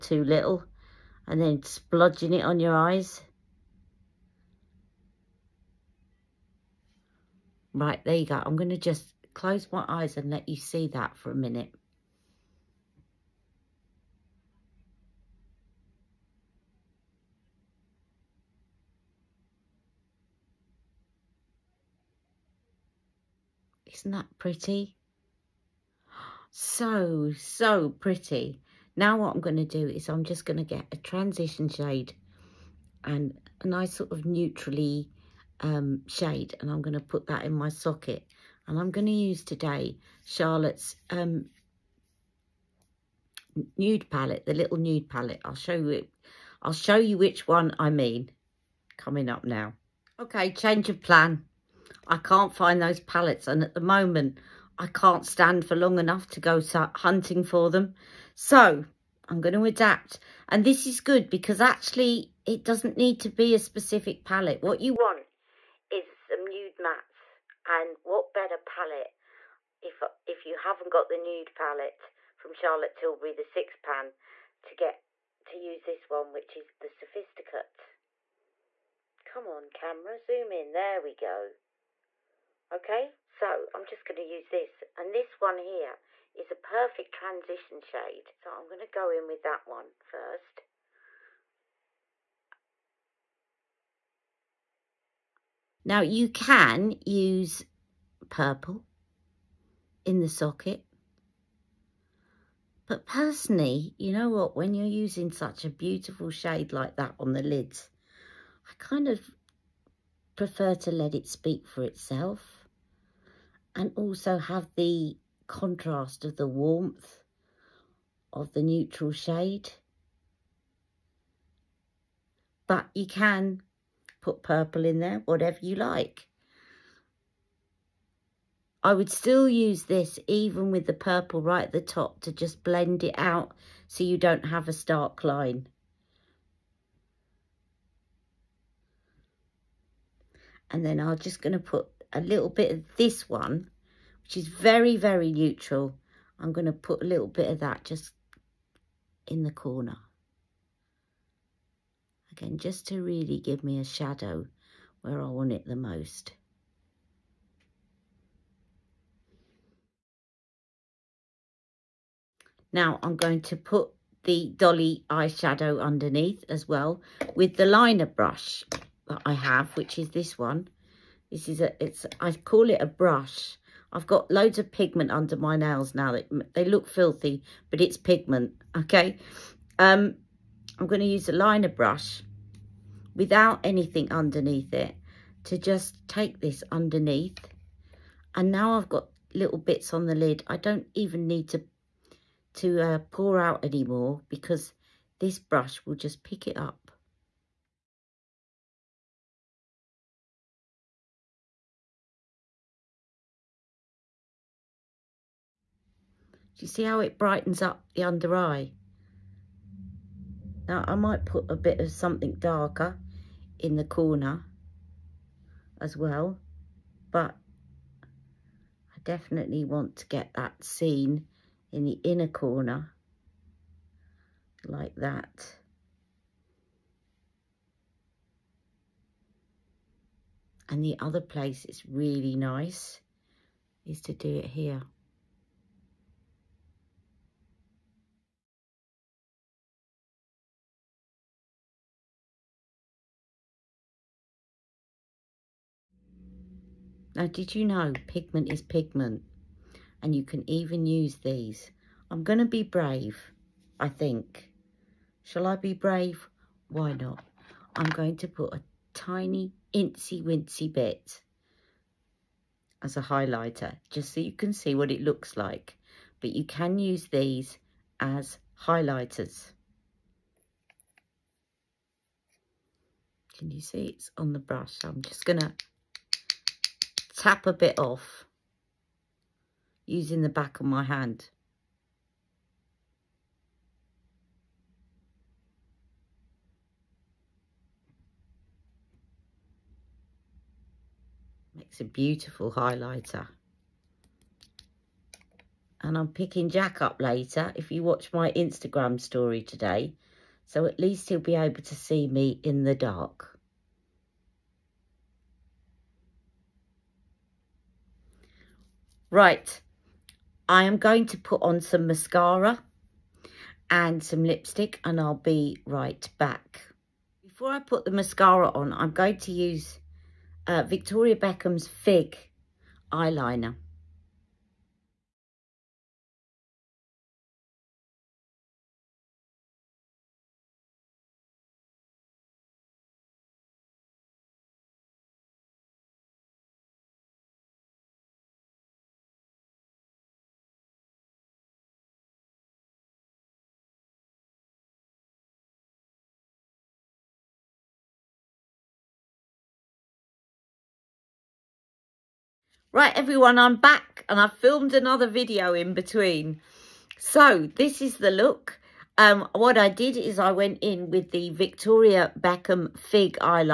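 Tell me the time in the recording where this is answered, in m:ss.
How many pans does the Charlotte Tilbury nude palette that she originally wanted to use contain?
1:13.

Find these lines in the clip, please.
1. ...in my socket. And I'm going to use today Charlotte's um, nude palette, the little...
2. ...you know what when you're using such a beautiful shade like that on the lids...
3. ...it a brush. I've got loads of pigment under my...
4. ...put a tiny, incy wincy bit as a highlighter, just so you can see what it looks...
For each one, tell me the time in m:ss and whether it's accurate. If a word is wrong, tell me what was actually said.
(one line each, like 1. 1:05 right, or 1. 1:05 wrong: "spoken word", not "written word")
1. 0:37 right
2. 1:43 right
3. 2:52 right
4. 4:18 right.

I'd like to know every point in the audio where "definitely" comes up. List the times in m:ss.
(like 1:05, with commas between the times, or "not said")
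3:39.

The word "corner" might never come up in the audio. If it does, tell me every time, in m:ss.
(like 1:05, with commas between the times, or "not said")
2:29, 3:33, 3:42.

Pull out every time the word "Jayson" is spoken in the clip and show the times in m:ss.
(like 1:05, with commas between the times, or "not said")
not said.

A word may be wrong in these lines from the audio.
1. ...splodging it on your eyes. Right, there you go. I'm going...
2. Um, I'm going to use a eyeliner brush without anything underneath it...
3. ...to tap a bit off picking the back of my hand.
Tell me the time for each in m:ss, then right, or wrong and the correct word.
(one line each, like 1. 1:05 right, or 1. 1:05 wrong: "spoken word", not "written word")
1. 0:01 right
2. 2:59 wrong: "liner", not "eyeliner"
3. 4:35 wrong: "using", not "picking".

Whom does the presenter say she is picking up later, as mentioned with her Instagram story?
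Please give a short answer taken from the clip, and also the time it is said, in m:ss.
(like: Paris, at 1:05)
Jack, at 4:56.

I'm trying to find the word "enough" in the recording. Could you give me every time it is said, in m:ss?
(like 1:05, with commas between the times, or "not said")
0:55.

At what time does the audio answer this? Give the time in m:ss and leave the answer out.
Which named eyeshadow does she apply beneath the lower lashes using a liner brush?
2:44.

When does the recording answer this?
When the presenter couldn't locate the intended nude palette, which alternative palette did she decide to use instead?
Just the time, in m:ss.
1:16.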